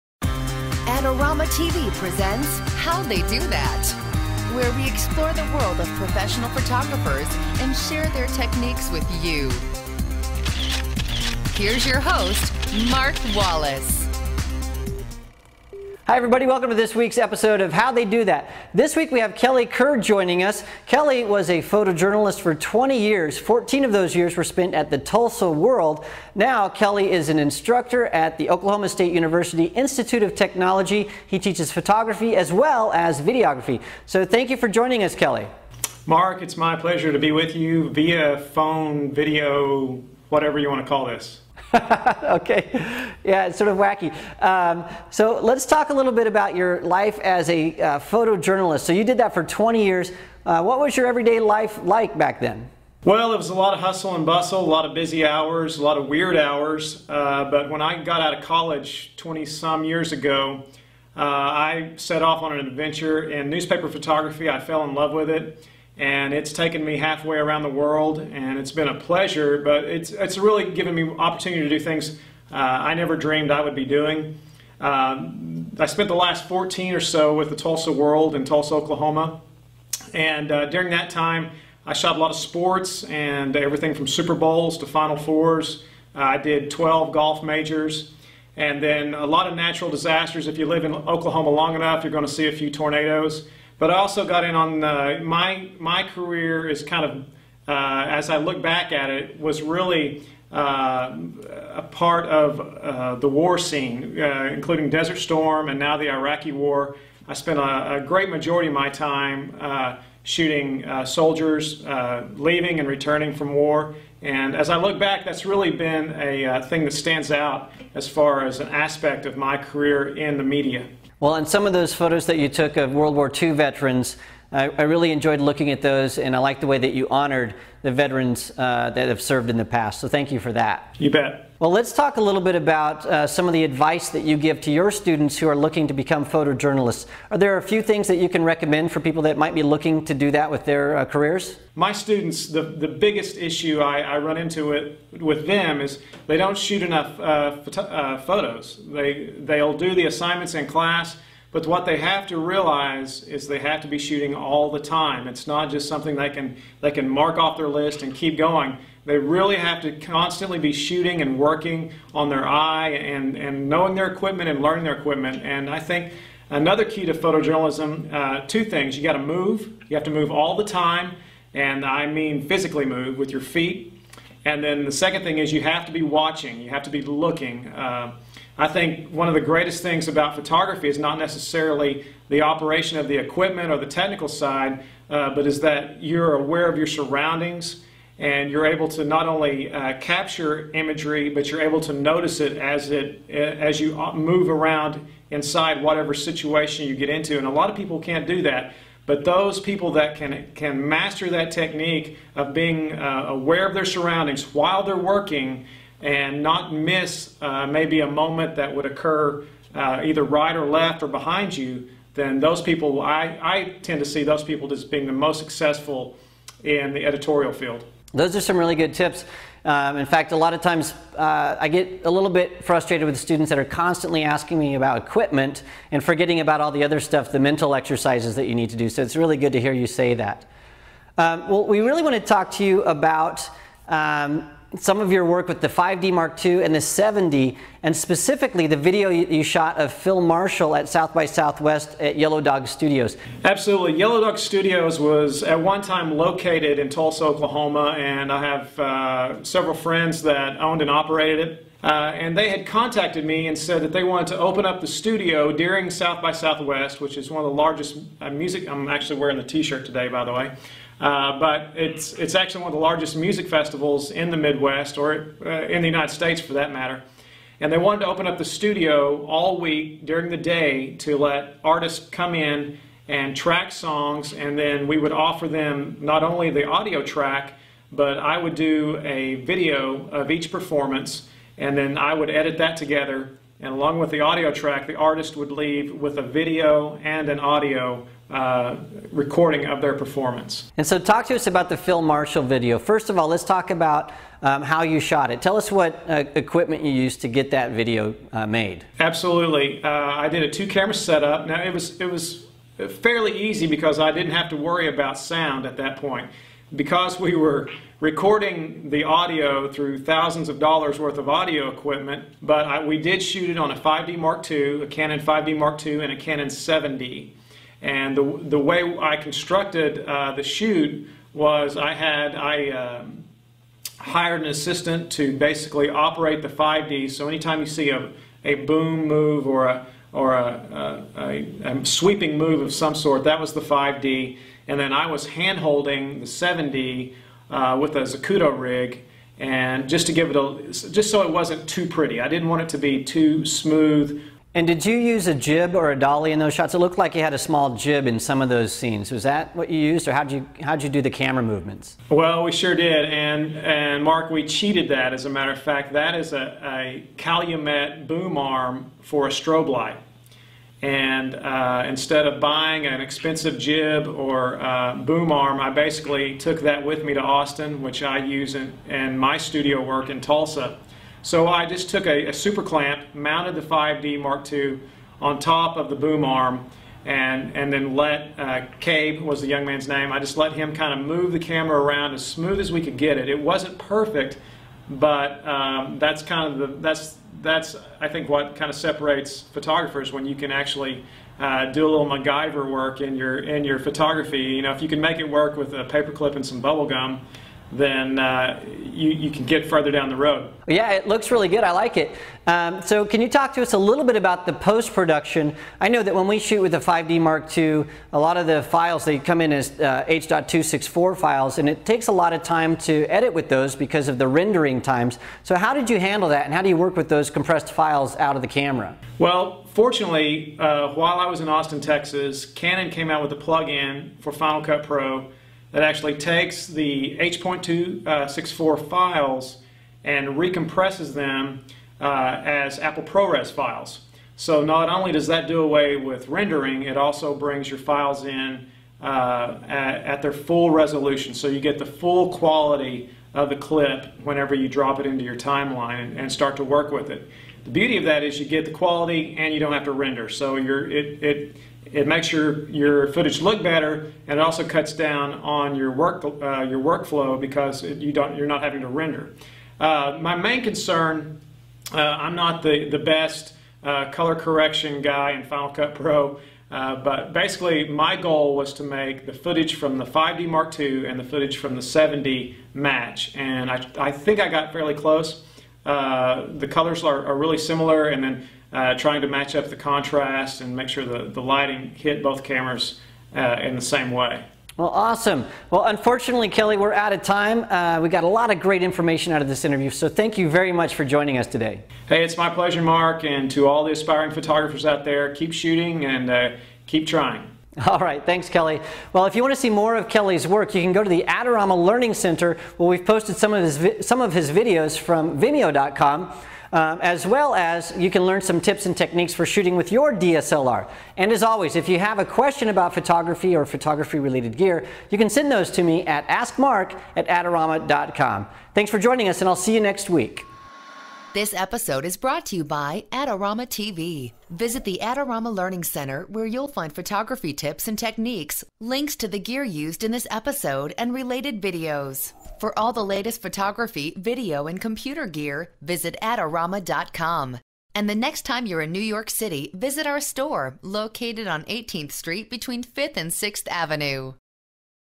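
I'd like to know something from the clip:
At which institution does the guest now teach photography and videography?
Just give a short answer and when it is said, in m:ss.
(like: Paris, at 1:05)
Oklahoma State University Institute of Technology, at 0:28.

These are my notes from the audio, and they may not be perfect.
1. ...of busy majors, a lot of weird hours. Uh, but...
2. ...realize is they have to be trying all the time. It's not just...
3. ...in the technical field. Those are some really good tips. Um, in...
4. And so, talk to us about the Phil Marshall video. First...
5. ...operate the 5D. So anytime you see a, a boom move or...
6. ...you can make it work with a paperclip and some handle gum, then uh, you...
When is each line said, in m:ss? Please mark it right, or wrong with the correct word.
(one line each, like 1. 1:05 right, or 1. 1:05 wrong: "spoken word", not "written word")
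1. 0:54 wrong: "hours", not "majors"
2. 2:32 wrong: "shooting", not "trying"
3. 3:36 wrong: "editorial", not "technical"
4. 4:50 right
5. 5:25 right
6. 6:34 wrong: "bubble", not "handle".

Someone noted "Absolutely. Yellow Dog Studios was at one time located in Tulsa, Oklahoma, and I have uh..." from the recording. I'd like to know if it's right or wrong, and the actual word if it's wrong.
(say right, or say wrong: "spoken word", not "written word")
right.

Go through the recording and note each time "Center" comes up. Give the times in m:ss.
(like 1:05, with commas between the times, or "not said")
8:22, 8:45.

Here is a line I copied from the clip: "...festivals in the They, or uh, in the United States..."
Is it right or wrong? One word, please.
wrong.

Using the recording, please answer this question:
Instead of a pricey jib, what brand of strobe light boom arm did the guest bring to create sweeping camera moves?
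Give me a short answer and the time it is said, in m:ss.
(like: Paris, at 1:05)
Calumet, at 5:57.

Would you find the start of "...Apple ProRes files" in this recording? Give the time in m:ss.
7:12.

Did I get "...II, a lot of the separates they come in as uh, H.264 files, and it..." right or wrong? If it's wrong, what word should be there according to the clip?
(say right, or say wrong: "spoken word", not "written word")
wrong: "files", not "separates".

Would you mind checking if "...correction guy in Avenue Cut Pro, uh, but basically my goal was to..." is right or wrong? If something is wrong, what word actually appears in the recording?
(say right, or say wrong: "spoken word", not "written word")
wrong: "Final", not "Avenue".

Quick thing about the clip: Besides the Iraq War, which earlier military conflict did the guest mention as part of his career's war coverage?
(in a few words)
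Desert Storm.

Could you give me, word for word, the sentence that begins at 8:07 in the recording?
Uh, we got a lot of great information out of this interview, so thank you very much for joining us today.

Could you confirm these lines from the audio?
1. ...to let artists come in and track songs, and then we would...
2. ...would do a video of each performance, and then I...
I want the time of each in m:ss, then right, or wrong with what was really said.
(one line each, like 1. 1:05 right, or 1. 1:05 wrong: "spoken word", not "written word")
1. 4:30 right
2. 4:38 right.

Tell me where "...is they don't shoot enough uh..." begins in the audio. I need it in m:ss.
2:25.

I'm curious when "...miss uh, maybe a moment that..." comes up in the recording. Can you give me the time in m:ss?
3:26.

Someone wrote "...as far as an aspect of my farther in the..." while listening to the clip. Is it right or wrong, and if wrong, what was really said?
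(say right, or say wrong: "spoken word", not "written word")
wrong: "career", not "farther".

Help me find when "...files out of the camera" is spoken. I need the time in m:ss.
6:57.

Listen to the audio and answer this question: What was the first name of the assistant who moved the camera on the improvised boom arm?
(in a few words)
Cabe.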